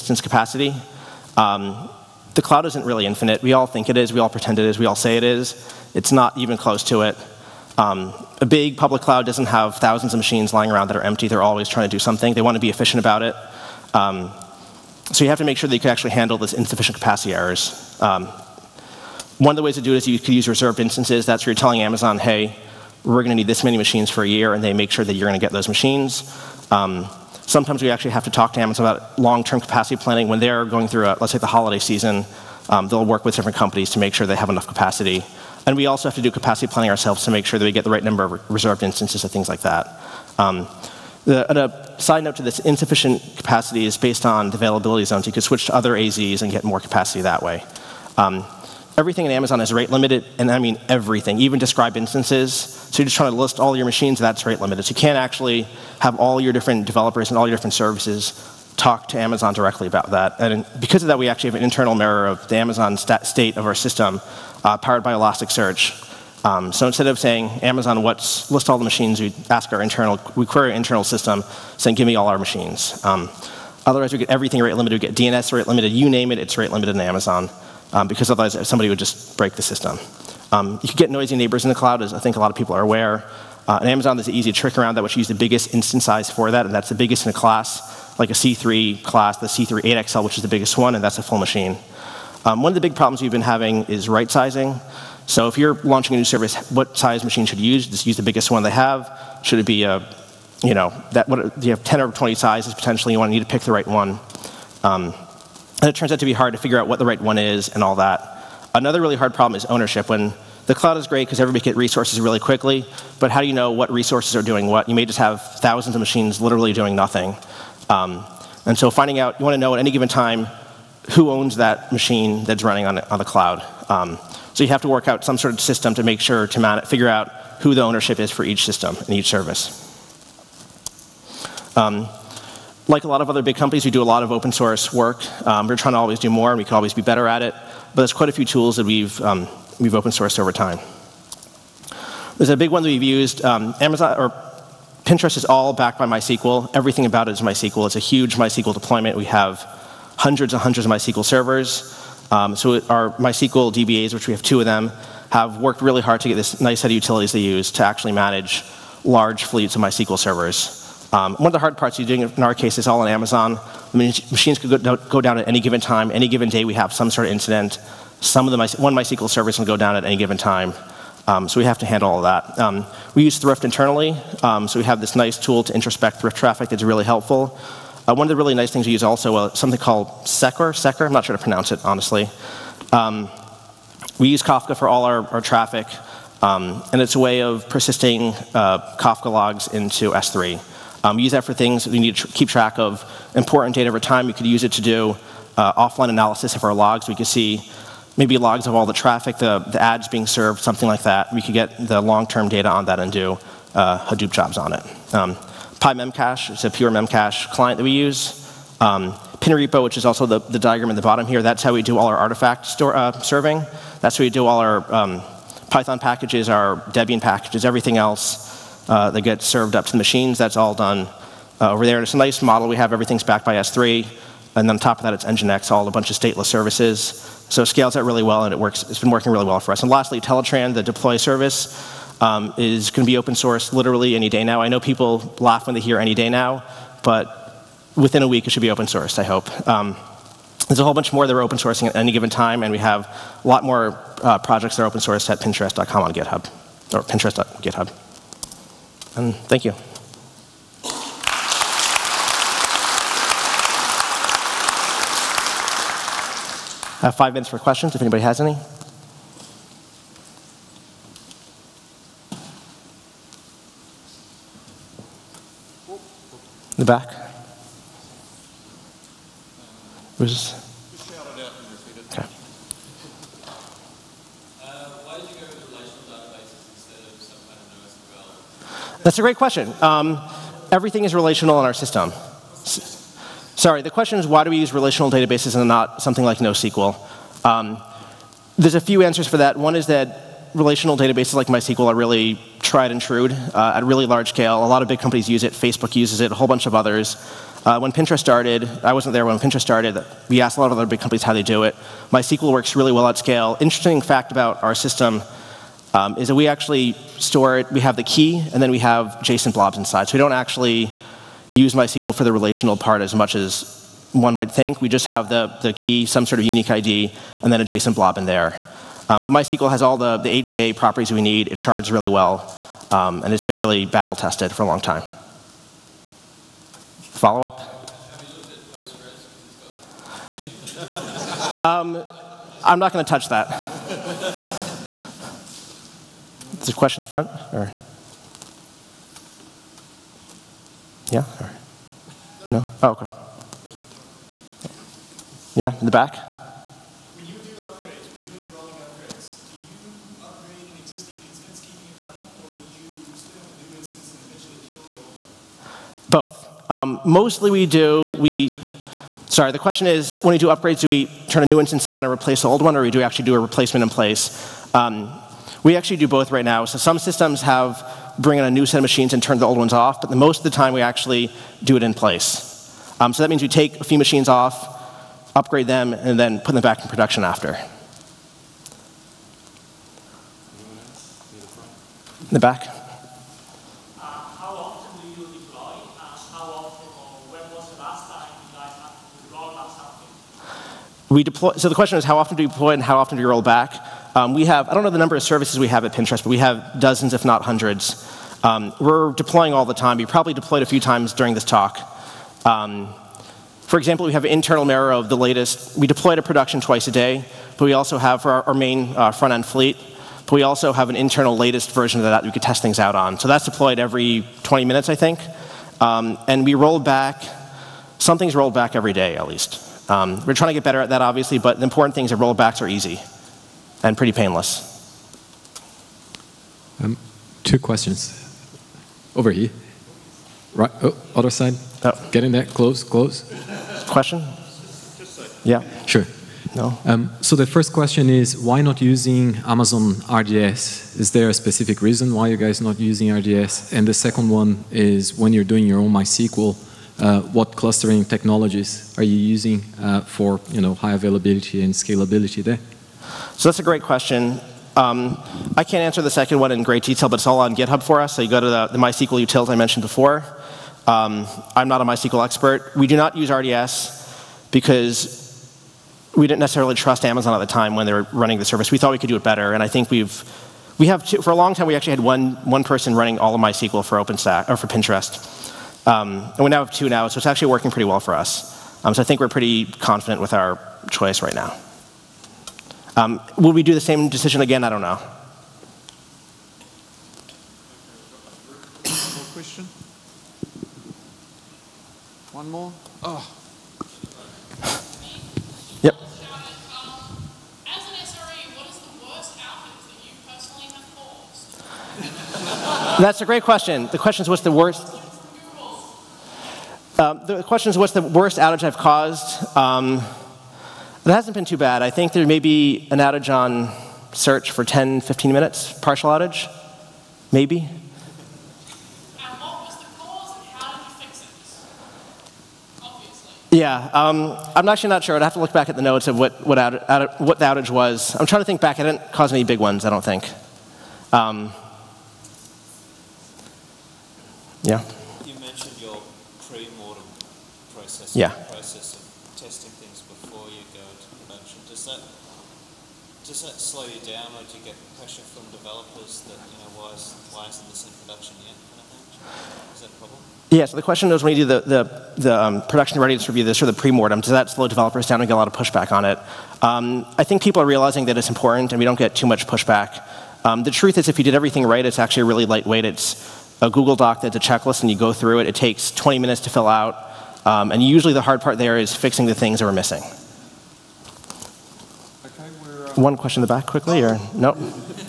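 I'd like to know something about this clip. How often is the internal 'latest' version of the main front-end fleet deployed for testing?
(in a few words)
Every 20 minutes.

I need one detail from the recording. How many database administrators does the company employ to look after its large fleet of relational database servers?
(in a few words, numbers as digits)
2.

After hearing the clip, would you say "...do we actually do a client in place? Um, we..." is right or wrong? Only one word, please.
wrong.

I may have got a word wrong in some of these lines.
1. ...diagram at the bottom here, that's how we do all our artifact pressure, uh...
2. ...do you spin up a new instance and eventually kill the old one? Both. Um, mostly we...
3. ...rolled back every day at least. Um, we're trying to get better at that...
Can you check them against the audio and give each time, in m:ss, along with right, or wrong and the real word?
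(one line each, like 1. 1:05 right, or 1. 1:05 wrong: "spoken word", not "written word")
1. 3:30 wrong: "store", not "pressure"
2. 5:52 right
3. 6:58 right.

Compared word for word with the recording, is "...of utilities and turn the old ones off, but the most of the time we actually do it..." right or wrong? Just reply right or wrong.
wrong.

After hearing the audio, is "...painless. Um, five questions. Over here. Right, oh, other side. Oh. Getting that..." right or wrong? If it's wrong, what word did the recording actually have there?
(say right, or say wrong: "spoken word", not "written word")
wrong: "two", not "five".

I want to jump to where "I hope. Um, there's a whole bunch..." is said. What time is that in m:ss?
3:59.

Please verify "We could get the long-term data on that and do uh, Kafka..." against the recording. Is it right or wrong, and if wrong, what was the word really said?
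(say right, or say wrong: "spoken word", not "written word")
wrong: "Hadoop", not "Kafka".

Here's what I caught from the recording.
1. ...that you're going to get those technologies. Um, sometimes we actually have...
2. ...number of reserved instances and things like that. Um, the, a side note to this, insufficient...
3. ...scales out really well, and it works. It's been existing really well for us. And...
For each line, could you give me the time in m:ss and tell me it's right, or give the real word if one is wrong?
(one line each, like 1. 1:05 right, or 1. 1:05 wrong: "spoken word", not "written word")
1. 0:25 wrong: "machines", not "technologies"
2. 0:38 right
3. 3:47 wrong: "working", not "existing".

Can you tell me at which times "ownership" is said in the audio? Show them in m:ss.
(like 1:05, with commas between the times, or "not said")
1:49, 2:07.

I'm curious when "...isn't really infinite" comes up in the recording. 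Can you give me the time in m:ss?
0:02.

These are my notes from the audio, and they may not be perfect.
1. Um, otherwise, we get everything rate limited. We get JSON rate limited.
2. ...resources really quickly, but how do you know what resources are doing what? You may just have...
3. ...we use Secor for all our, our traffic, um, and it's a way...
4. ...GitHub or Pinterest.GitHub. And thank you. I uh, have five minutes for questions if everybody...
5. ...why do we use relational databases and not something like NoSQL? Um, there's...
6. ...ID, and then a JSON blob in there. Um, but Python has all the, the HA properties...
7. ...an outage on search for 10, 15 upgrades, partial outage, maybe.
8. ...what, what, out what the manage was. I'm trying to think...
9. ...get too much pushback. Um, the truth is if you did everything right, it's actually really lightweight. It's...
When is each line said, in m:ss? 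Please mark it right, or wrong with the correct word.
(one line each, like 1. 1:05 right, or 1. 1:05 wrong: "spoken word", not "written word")
1. 1:13 wrong: "DNS", not "JSON"
2. 1:51 right
3. 3:04 wrong: "Kafka", not "Secor"
4. 4:06 wrong: "anybody", not "everybody"
5. 4:44 right
6. 5:16 wrong: "MySQL", not "Python"
7. 8:32 wrong: "minutes", not "upgrades"
8. 8:46 wrong: "outage", not "manage"
9. 9:18 right.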